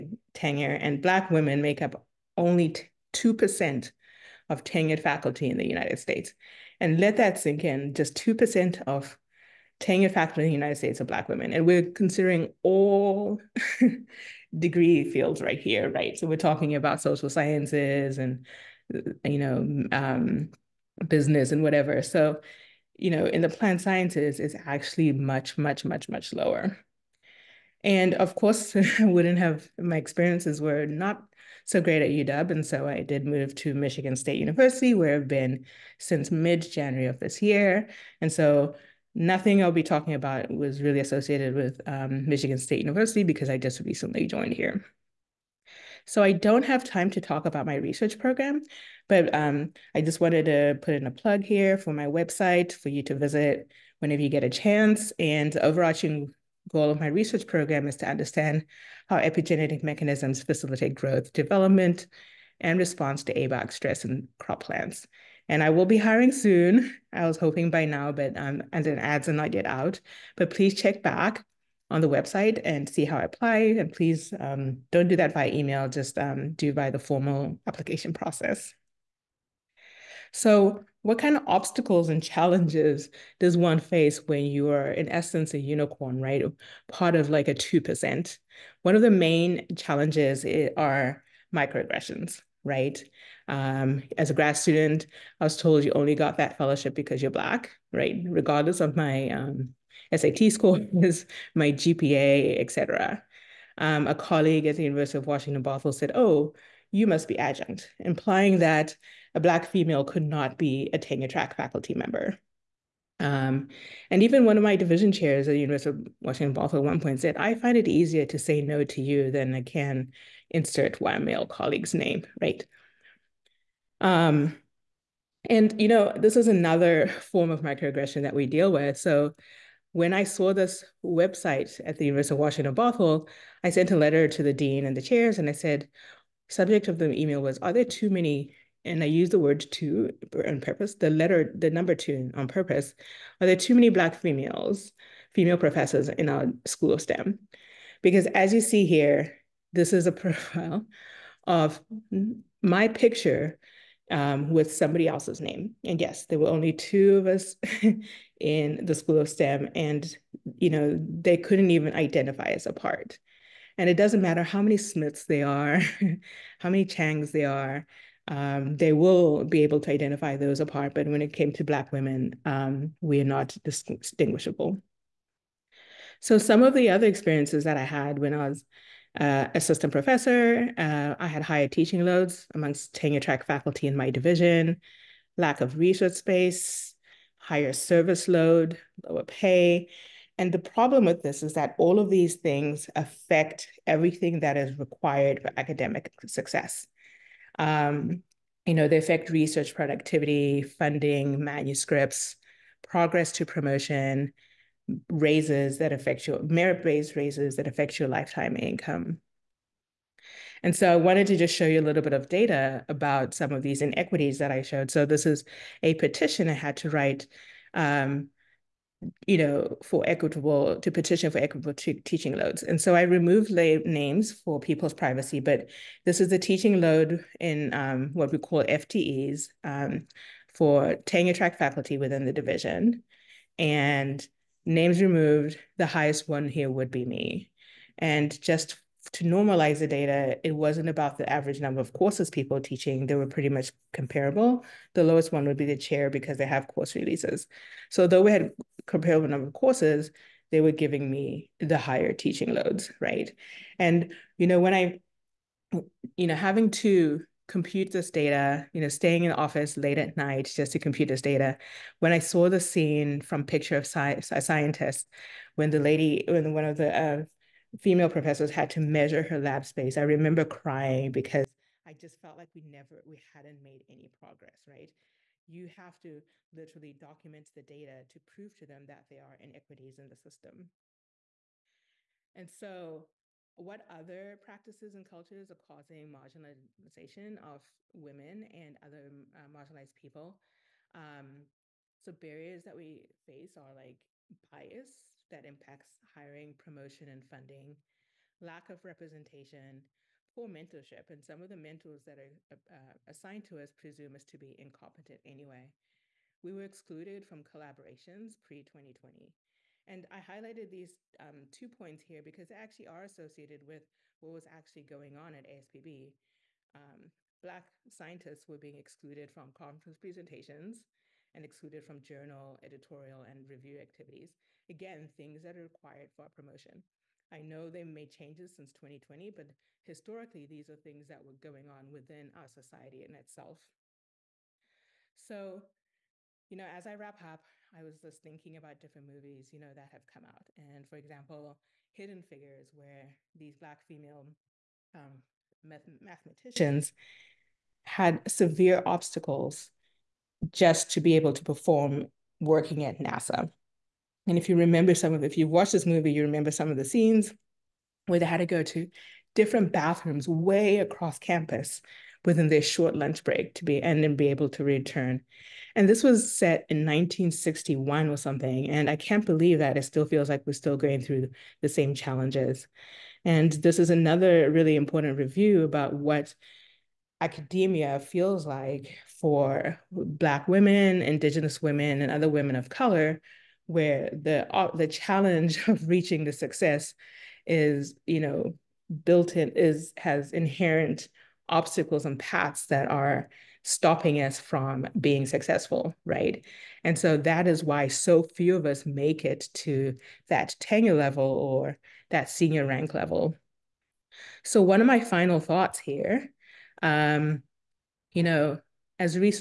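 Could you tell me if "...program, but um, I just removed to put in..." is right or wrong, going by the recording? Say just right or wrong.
wrong.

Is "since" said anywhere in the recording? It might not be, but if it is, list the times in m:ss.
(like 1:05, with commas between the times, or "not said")
0:35, 5:28.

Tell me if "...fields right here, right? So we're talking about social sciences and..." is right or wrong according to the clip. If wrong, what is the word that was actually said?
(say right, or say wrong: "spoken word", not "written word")
right.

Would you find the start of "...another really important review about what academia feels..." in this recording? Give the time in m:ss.
6:13.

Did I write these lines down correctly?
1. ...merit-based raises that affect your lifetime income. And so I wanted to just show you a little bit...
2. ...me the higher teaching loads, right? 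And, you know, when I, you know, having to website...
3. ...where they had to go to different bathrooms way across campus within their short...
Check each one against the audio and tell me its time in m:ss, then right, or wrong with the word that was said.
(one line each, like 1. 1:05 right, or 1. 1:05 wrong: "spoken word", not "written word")
1. 3:26 right
2. 4:11 wrong: "compute", not "website"
3. 5:58 right.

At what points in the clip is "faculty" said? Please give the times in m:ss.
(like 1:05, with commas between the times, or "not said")
0:05, 0:10, 1:51, 3:03, 3:51.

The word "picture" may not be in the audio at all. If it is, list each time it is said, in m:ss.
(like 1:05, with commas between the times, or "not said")
2:32, 4:23.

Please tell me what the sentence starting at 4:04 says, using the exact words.
The lowest one would be the chair because they have course releases.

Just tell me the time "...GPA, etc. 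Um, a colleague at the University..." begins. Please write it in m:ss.
1:41.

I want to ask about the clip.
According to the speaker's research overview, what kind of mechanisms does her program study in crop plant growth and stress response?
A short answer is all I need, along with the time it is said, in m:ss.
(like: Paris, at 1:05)
Epigenetic, at 0:59.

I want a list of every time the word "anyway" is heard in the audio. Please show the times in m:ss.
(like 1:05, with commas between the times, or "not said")
5:05.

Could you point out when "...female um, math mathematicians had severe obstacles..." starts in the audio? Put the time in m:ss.
5:43.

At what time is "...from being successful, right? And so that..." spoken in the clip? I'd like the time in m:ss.
6:34.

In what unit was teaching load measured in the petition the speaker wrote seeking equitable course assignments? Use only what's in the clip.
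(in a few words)
FTEs.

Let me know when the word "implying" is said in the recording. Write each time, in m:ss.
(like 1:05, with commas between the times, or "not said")
1:47.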